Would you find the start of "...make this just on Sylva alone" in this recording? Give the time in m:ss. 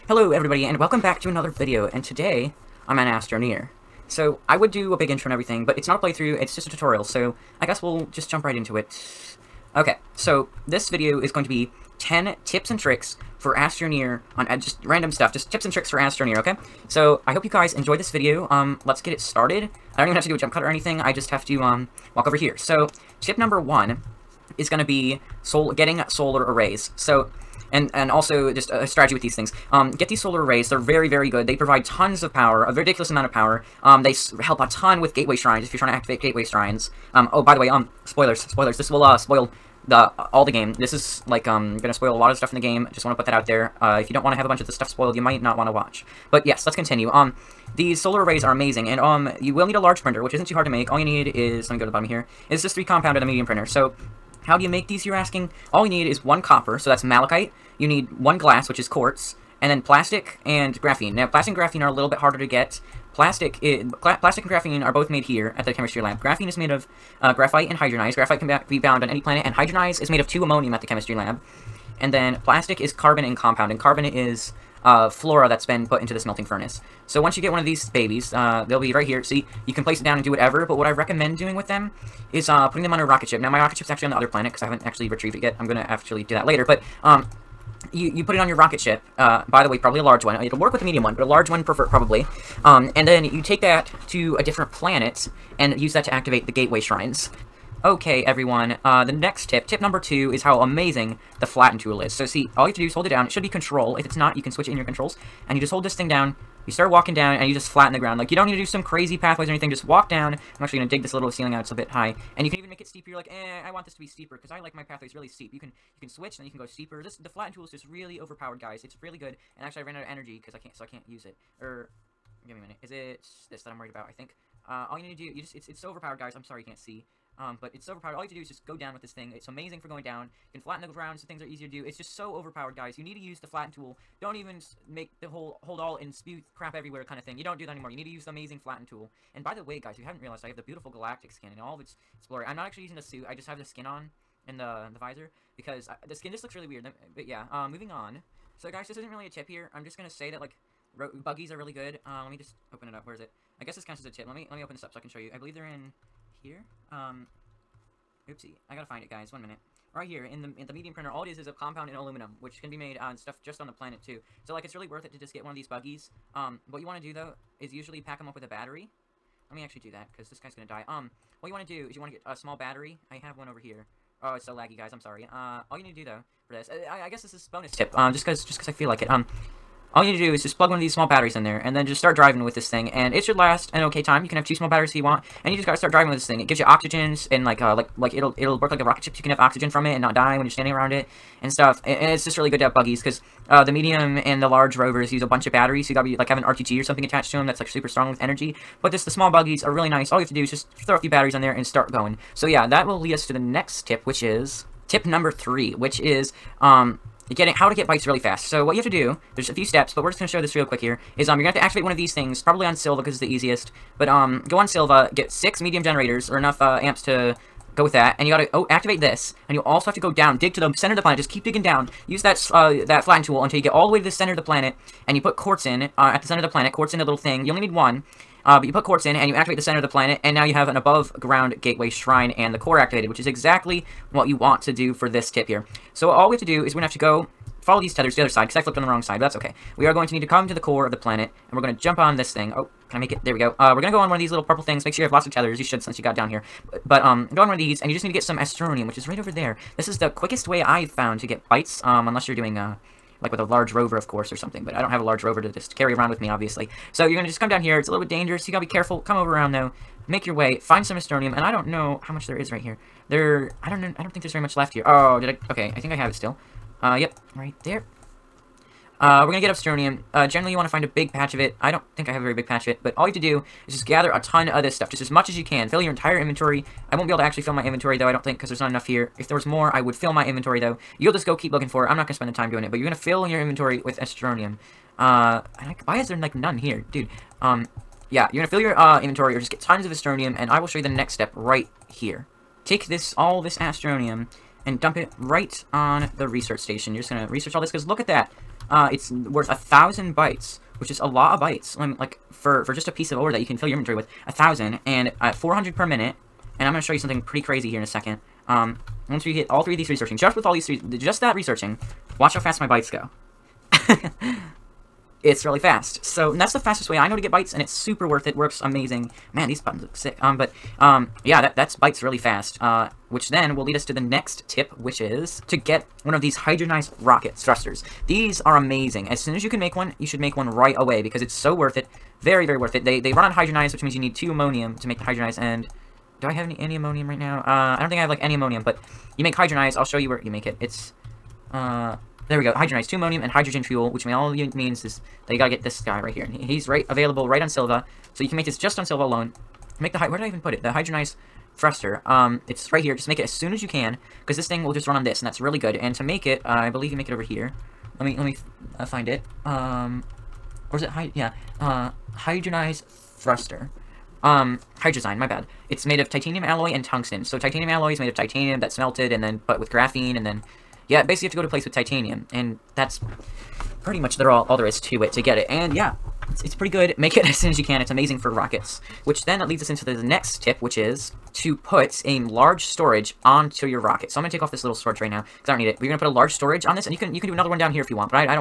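5:48.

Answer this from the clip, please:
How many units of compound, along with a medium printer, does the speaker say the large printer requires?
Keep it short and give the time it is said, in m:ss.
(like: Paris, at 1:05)
3, at 0:52.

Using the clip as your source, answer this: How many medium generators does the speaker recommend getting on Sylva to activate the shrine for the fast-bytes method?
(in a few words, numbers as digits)
6.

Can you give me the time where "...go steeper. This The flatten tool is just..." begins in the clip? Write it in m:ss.
1:56.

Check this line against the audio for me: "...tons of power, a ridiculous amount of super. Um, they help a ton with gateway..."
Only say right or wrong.
wrong.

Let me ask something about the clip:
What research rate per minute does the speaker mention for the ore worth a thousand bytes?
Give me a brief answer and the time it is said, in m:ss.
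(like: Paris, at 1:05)
400, at 5:05.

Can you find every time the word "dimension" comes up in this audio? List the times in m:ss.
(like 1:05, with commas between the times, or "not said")
not said.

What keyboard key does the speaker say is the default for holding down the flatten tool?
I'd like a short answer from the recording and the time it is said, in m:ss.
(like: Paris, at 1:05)
control, at 1:43.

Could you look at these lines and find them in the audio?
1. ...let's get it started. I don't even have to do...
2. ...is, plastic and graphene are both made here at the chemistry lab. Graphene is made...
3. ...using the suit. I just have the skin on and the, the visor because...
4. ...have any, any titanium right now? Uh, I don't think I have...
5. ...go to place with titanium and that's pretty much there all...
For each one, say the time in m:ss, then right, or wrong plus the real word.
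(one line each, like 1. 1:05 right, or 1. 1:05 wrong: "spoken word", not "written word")
1. 0:18 right
2. 1:03 right
3. 2:22 right
4. 5:36 wrong: "ammonium", not "titanium"
5. 6:11 right.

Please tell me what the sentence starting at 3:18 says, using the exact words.
But just the small buggies are really nice.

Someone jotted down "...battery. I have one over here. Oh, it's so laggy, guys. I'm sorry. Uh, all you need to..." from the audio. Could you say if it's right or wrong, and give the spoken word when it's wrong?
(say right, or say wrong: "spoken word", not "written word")
right.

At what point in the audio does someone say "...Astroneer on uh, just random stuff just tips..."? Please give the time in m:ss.
0:13.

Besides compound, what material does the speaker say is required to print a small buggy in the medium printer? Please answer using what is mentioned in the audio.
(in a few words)
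aluminum.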